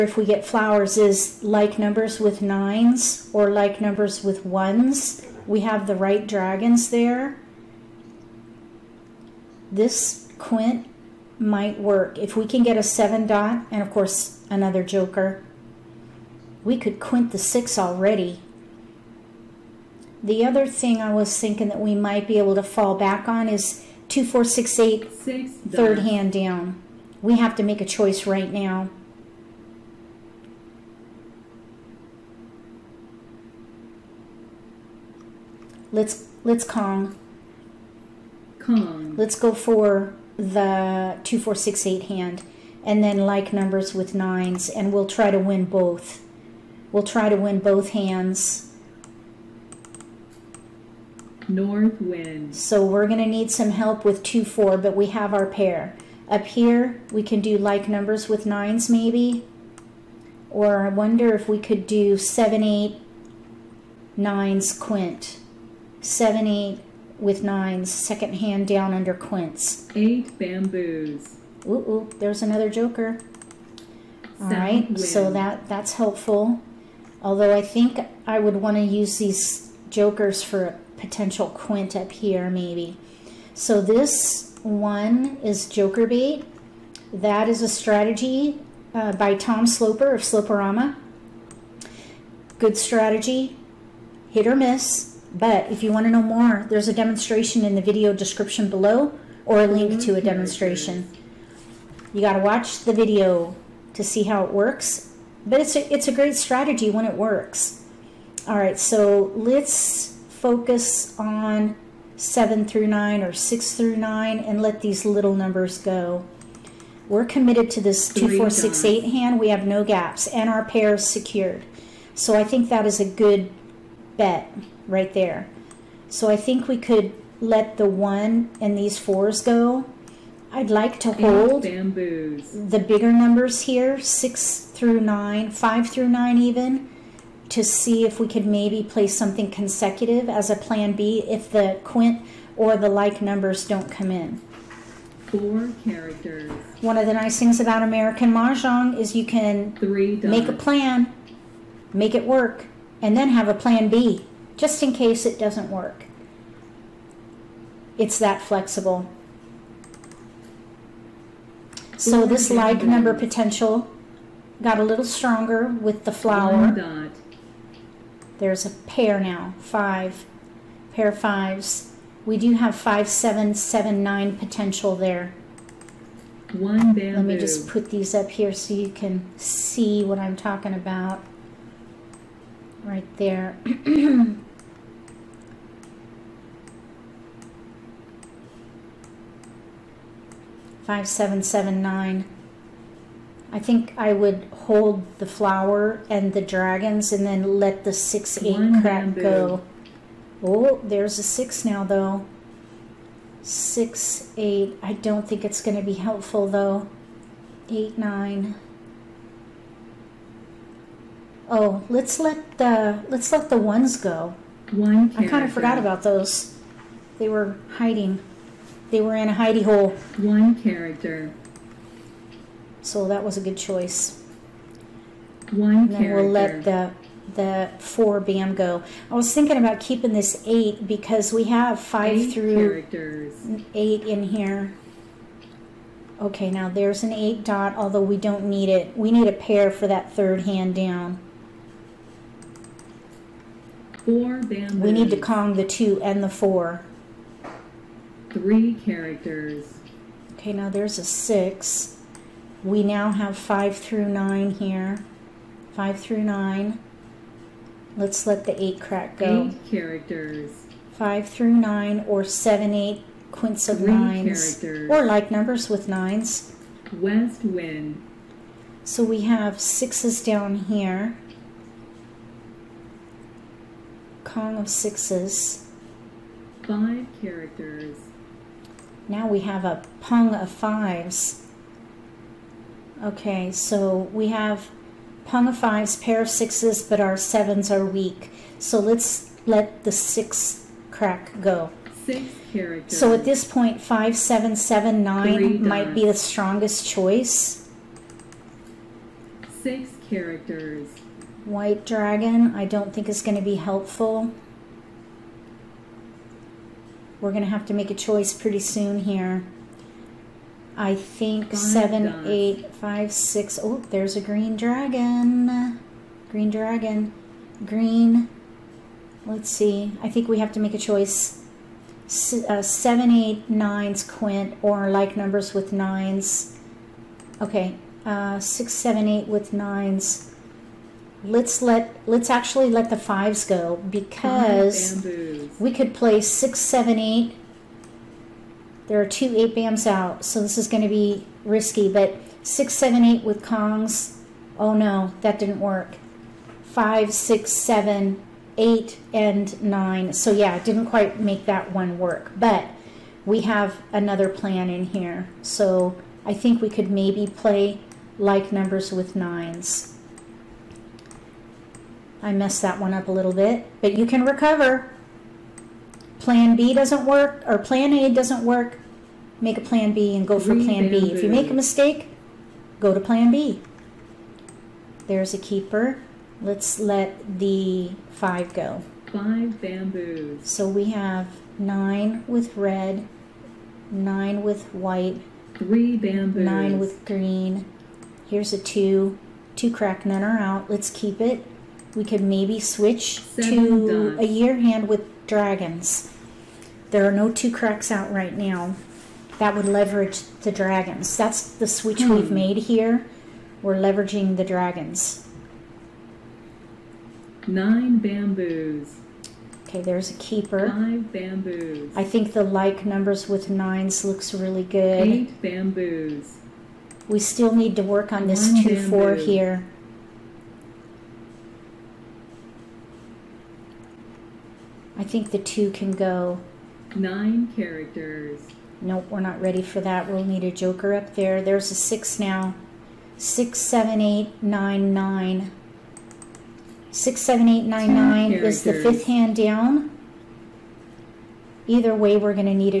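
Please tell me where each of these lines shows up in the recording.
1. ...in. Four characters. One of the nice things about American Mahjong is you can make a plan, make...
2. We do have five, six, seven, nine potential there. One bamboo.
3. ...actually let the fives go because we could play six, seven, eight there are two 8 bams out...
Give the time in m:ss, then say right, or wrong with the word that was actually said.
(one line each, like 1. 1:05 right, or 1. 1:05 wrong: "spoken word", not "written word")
1. 2:24 right
2. 2:52 wrong: "seven", not "six"
3. 5:32 right.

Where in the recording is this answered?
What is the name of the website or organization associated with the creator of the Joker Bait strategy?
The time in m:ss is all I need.
1:30.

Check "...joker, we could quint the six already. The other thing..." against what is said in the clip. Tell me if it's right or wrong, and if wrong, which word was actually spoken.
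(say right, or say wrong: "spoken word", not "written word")
right.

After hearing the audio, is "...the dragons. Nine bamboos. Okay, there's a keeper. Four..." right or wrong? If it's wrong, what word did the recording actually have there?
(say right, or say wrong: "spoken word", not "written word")
wrong: "Five", not "Four".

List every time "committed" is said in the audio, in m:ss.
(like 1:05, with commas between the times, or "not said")
1:57.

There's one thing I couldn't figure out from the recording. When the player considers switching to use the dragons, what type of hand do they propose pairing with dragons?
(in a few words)
a year hand.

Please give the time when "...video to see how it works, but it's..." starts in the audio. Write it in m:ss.
1:42.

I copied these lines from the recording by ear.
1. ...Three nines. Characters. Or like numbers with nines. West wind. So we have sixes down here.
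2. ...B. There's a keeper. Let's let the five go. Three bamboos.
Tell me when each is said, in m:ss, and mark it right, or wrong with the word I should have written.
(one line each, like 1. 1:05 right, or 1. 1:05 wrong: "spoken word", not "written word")
1. 4:23 right
2. 6:13 wrong: "Five", not "Three".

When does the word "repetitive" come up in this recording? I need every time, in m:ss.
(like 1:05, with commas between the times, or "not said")
not said.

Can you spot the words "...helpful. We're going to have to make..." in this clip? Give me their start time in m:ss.
5:03.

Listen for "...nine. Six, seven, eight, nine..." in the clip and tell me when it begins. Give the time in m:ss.
7:14.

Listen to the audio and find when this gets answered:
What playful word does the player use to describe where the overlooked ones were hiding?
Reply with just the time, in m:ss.
3:39.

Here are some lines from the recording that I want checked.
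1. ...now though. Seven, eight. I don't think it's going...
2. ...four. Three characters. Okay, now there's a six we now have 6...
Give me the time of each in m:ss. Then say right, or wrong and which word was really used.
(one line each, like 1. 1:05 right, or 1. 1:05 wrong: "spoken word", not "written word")
1. 3:21 wrong: "Six", not "Seven"
2. 4:06 wrong: "5", not "6".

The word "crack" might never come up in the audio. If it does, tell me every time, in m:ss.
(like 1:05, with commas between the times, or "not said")
4:18, 4:50, 6:29, 6:37.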